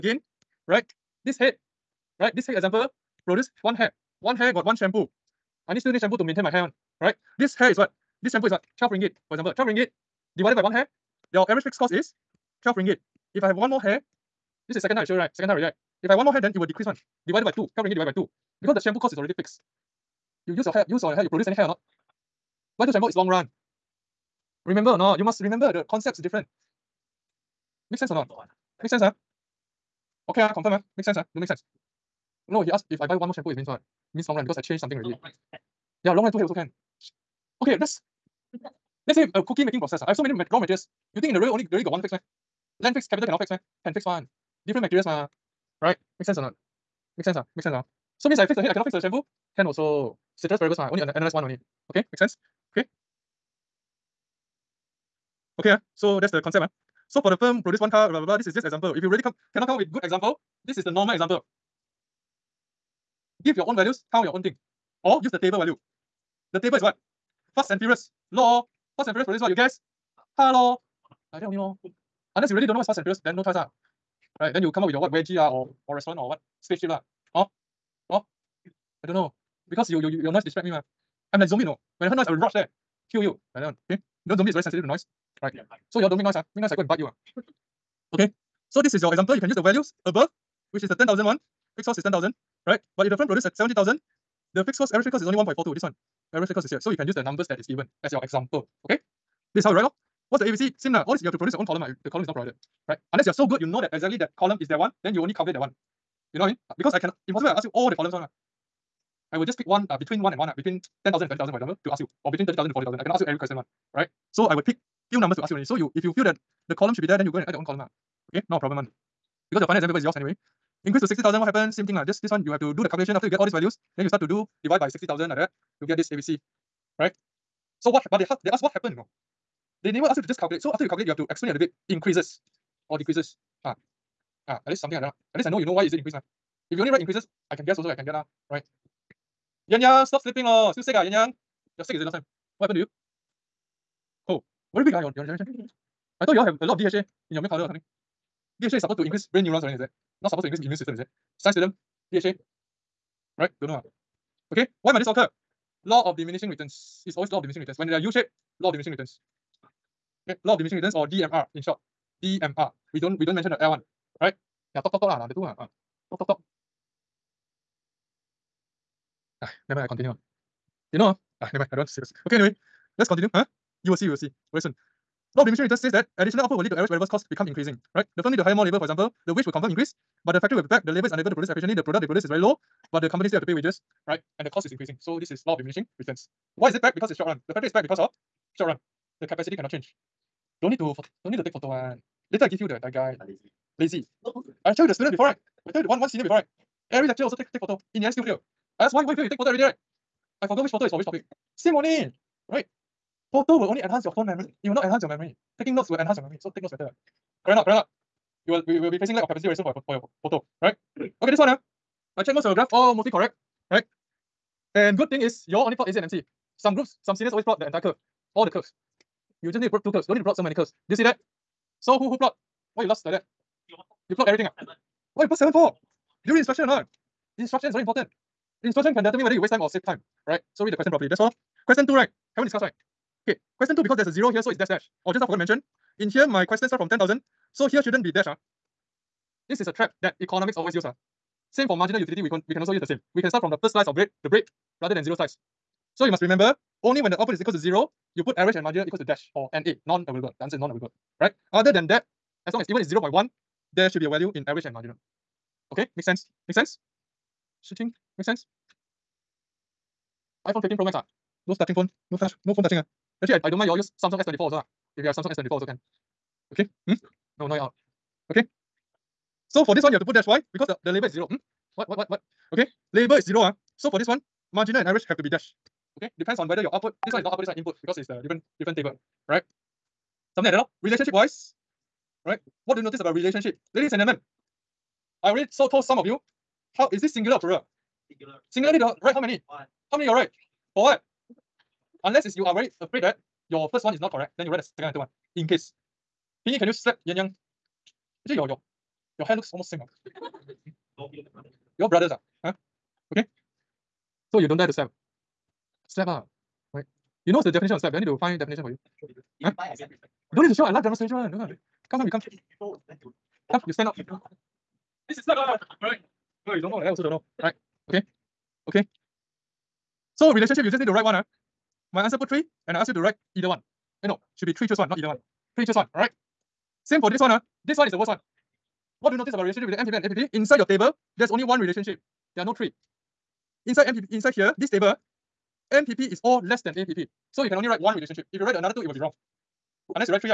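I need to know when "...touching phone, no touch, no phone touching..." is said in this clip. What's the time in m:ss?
4:21.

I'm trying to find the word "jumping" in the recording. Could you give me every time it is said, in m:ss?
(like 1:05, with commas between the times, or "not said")
not said.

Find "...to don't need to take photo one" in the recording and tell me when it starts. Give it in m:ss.
3:10.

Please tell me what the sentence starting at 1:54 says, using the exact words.
So I would pick few numbers to ask you already.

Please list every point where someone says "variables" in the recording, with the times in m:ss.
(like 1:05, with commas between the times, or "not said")
0:50, 2:56.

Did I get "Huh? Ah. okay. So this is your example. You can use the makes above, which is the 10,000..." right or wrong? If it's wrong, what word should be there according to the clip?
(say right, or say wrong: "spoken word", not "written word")
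wrong: "values", not "makes".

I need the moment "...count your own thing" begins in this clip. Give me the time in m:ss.
1:04.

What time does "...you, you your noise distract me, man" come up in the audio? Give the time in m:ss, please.
1:19.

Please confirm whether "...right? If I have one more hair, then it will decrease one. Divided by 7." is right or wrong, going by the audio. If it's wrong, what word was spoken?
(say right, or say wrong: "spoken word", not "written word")
wrong: "2", not "7".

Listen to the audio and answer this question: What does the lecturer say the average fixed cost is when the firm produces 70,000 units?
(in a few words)
1.42.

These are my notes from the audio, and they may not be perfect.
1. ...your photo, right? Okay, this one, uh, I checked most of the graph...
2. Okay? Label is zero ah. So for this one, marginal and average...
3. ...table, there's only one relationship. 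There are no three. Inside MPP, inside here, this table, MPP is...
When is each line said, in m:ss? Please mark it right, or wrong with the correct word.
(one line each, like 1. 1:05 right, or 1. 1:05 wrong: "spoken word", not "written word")
1. 3:29 right
2. 4:32 right
3. 5:30 right.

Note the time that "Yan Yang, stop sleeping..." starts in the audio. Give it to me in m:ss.
2:19.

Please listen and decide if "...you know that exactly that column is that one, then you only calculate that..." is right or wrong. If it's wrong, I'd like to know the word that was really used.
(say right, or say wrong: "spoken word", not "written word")
right.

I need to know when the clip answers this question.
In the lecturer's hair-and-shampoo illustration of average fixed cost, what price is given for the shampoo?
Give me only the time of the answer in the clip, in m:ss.
0:08.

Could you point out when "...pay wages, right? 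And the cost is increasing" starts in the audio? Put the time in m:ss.
3:03.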